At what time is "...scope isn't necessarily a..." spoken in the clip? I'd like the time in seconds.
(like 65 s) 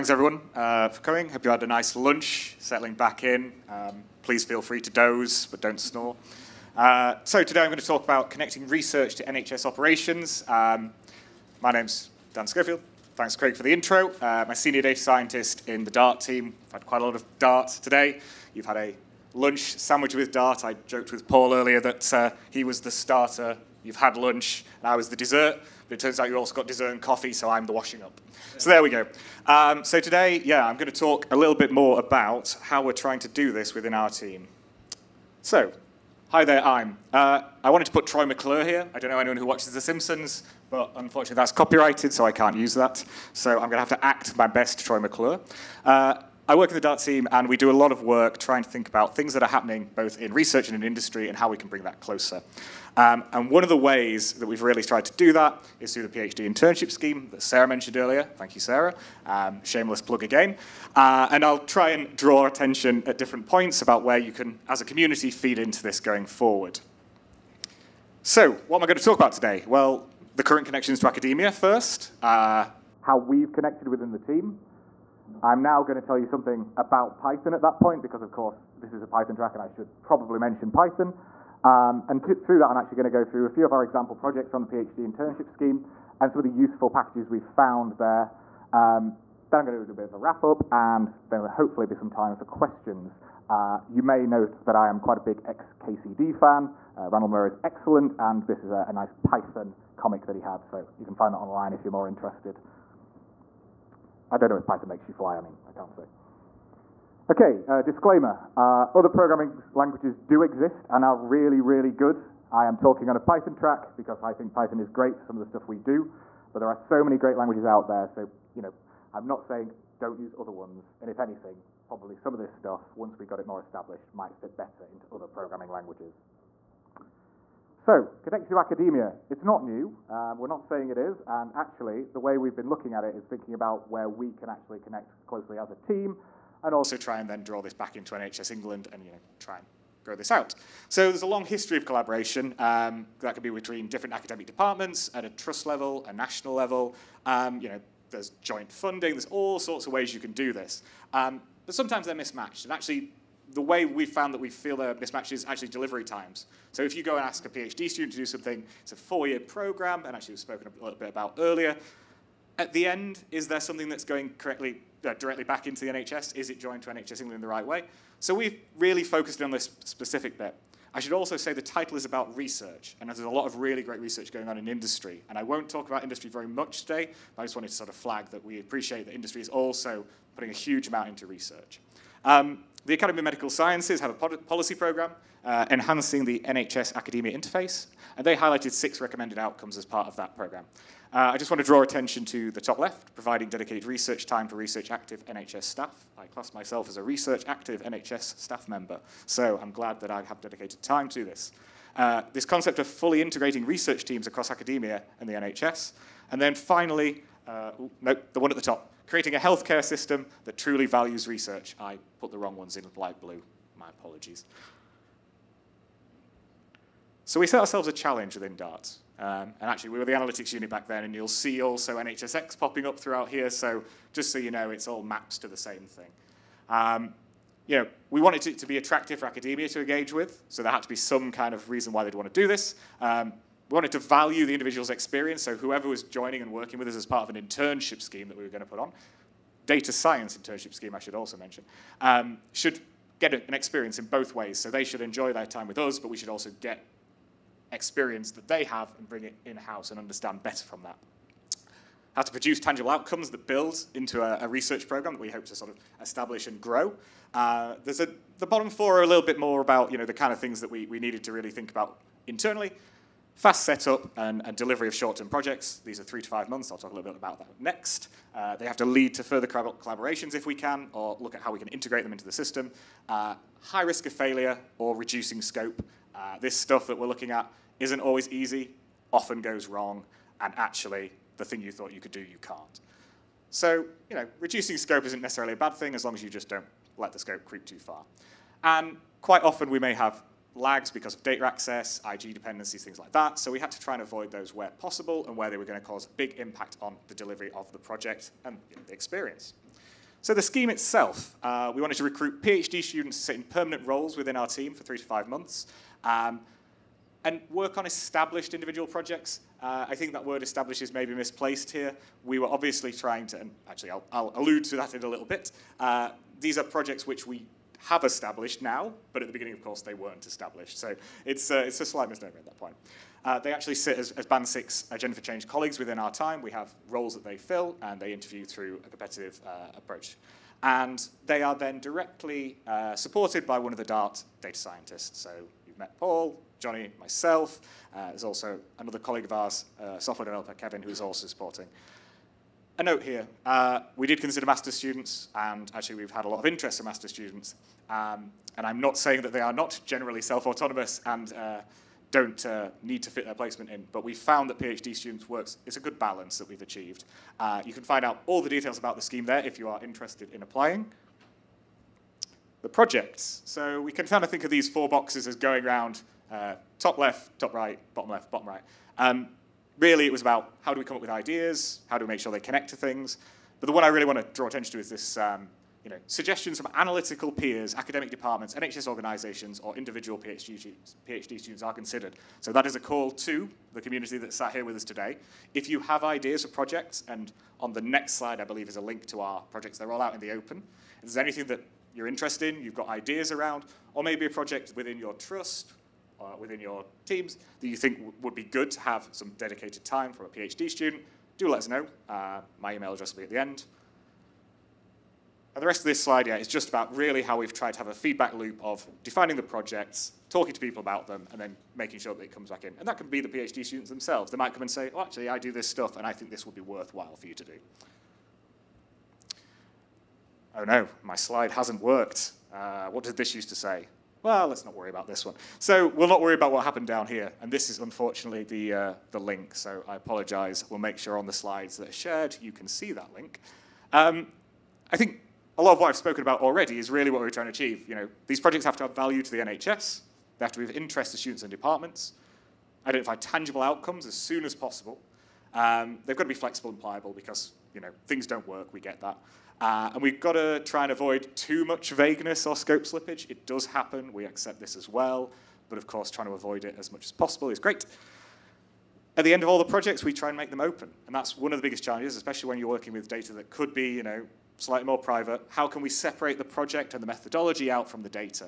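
284 s.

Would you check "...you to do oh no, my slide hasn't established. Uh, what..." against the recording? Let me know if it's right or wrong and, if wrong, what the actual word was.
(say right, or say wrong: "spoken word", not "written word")
wrong: "worked", not "established".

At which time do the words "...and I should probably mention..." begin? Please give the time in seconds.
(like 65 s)
79 s.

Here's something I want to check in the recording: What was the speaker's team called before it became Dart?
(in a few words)
the analytics unit.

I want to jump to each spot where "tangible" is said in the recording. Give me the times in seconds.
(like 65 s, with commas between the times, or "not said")
252 s, 443 s.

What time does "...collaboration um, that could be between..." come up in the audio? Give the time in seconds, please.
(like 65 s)
141 s.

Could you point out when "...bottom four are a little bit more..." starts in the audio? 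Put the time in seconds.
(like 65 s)
258 s.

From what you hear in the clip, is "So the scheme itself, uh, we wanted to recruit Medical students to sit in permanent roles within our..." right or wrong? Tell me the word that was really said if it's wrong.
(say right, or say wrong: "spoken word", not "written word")
wrong: "PhD", not "Medical".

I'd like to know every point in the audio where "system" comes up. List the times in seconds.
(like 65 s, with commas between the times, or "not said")
209 s, 272 s.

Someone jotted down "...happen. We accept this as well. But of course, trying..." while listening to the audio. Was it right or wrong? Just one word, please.
right.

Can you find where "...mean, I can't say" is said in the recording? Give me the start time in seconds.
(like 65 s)
105 s.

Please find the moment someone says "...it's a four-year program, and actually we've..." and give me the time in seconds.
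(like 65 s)
158 s.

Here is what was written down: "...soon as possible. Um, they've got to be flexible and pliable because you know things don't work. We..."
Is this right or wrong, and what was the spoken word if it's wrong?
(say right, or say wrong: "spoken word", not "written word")
right.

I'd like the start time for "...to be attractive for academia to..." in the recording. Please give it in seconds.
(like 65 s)
228 s.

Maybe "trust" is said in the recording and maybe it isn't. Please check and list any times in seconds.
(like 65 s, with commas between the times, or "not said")
145 s, 395 s.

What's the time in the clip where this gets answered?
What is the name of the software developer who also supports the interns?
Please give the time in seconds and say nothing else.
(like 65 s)
340 s.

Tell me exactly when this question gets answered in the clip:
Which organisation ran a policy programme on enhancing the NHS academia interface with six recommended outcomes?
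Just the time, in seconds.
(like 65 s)
182 s.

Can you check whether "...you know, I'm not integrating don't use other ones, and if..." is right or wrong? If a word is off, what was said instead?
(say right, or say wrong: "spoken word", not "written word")
wrong: "saying", not "integrating".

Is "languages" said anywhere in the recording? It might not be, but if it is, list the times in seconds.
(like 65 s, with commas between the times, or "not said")
109 s, 117 s, 125 s.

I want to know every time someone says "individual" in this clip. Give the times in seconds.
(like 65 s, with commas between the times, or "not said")
234 s, 308 s, 379 s.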